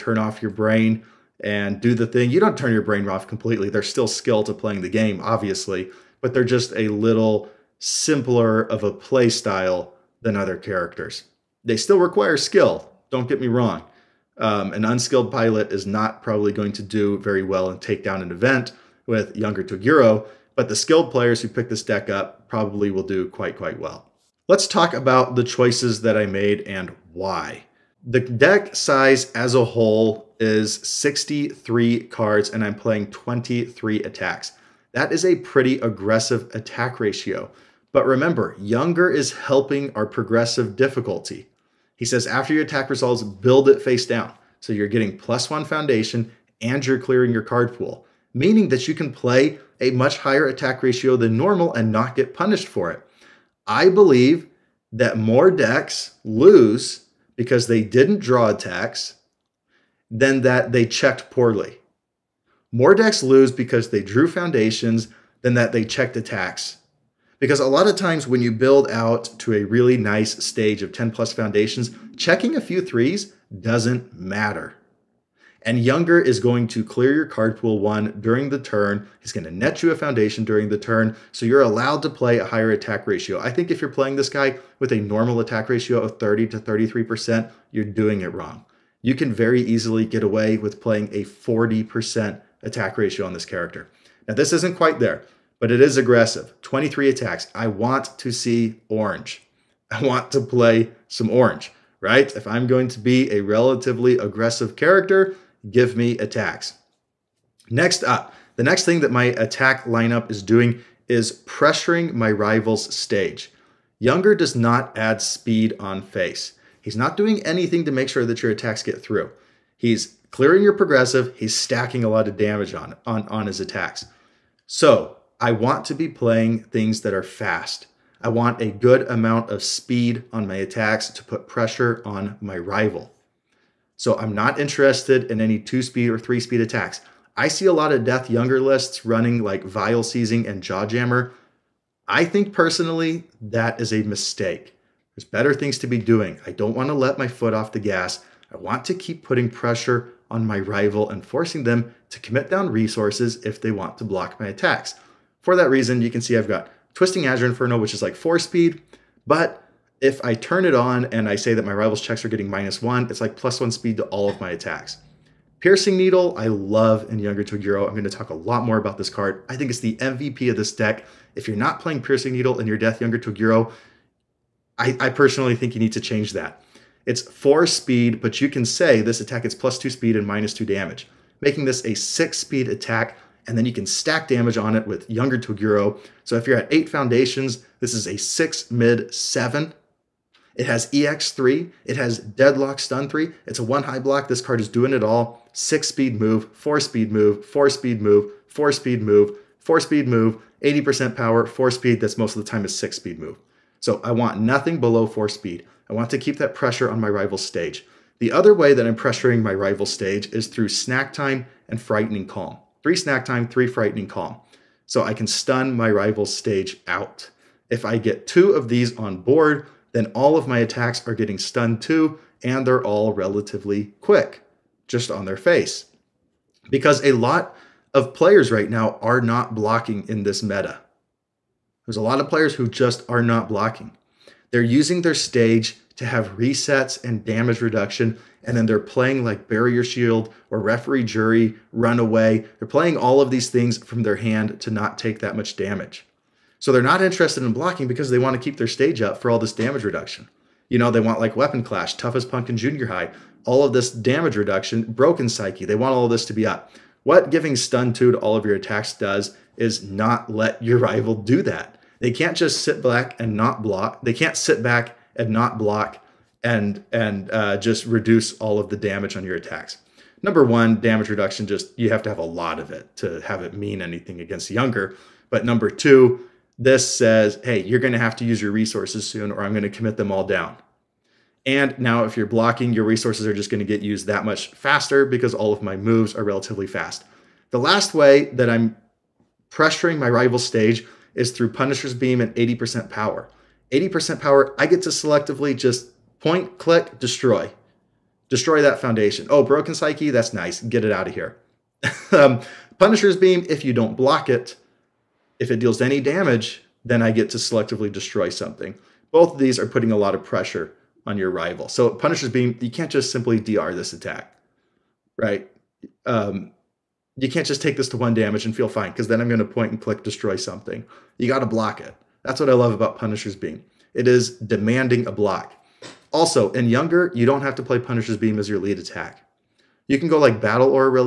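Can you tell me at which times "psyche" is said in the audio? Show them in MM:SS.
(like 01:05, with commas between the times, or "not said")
04:15, 04:59.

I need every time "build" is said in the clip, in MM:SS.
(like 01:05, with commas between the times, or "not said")
00:43, 01:08.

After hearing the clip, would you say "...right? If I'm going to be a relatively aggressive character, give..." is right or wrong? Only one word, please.
right.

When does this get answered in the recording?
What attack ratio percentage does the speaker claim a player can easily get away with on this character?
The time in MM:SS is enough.
01:31.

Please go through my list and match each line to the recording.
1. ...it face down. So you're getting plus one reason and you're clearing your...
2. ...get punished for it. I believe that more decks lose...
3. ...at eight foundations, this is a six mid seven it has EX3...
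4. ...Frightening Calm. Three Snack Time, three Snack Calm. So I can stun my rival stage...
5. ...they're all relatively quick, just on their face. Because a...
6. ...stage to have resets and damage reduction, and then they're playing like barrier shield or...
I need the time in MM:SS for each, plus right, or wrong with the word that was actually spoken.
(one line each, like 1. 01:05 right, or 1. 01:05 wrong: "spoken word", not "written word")
1. 00:43 wrong: "foundation", not "reason"
2. 00:52 right
3. 03:06 right
4. 03:31 wrong: "Frightening", not "Snack"
5. 03:42 right
6. 03:55 right.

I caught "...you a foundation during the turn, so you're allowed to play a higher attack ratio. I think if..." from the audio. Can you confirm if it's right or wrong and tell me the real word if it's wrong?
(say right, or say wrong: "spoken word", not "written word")
right.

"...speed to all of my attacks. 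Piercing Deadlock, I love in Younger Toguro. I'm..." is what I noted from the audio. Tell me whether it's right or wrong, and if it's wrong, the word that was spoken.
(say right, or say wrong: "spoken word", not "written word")
wrong: "Needle", not "Deadlock".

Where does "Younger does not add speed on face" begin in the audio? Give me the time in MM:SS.
01:53.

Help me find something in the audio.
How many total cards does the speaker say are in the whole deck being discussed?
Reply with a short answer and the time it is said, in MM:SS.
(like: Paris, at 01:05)
63, at 00:30.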